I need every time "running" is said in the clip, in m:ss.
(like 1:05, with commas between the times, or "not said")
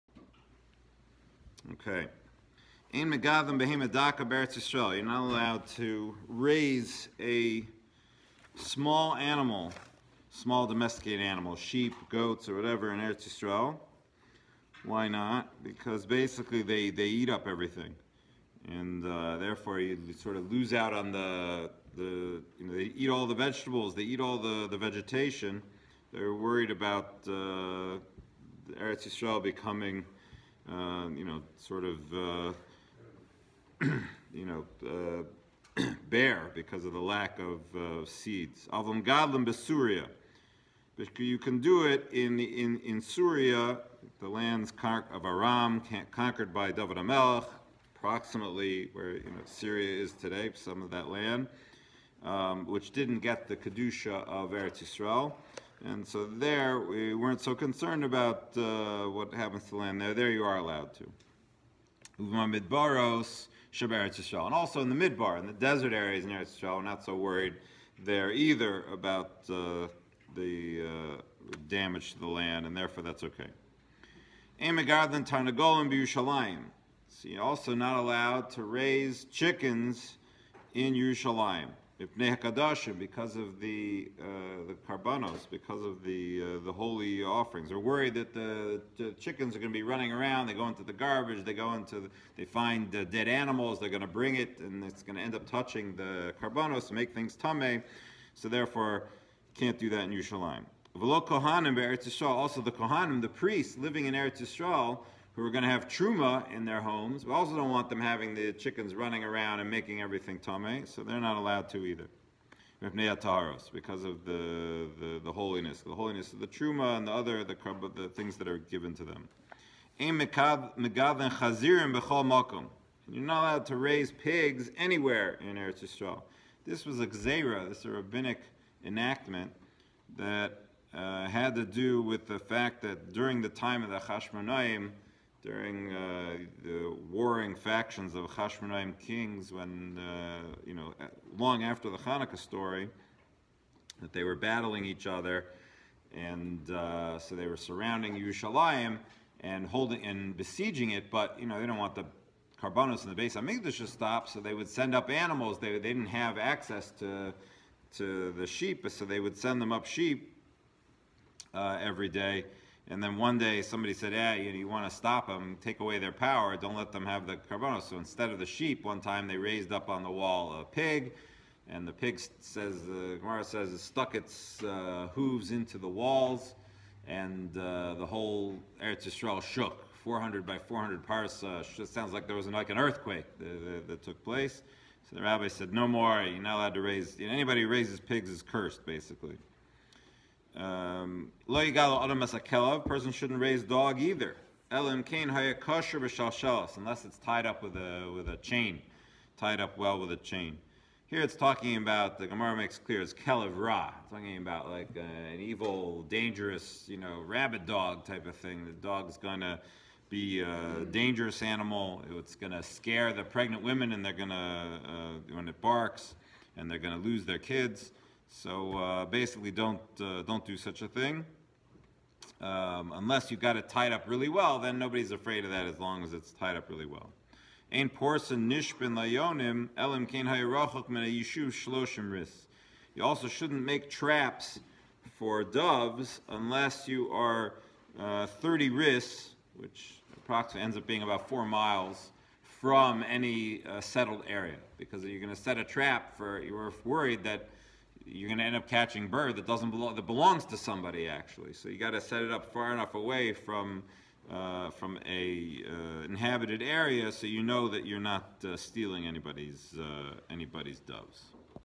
1:29, 1:48.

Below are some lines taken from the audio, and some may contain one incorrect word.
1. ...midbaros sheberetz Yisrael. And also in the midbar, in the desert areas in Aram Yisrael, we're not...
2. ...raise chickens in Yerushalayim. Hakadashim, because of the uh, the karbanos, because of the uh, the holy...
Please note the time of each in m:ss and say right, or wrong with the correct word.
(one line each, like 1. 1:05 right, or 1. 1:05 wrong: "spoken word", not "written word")
1. 1:02 wrong: "Eretz", not "Aram"
2. 1:18 right.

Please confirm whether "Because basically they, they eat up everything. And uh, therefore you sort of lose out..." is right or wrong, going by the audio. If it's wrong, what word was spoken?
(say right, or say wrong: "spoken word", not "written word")
right.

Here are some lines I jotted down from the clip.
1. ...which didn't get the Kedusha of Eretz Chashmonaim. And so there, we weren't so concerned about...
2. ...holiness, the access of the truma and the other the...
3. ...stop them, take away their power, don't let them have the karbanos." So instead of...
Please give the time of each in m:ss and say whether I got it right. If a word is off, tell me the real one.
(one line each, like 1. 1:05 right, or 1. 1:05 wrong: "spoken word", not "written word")
1. 0:52 wrong: "Yisrael", not "Chashmonaim"
2. 1:55 wrong: "holiness", not "access"
3. 2:44 right.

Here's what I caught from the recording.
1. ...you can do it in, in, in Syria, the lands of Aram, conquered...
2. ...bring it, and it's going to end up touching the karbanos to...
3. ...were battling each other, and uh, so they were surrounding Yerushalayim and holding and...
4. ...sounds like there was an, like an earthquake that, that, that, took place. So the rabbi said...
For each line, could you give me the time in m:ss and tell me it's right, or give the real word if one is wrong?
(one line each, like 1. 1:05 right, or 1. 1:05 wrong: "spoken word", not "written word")
1. 0:41 right
2. 1:34 right
3. 2:24 right
4. 3:01 right.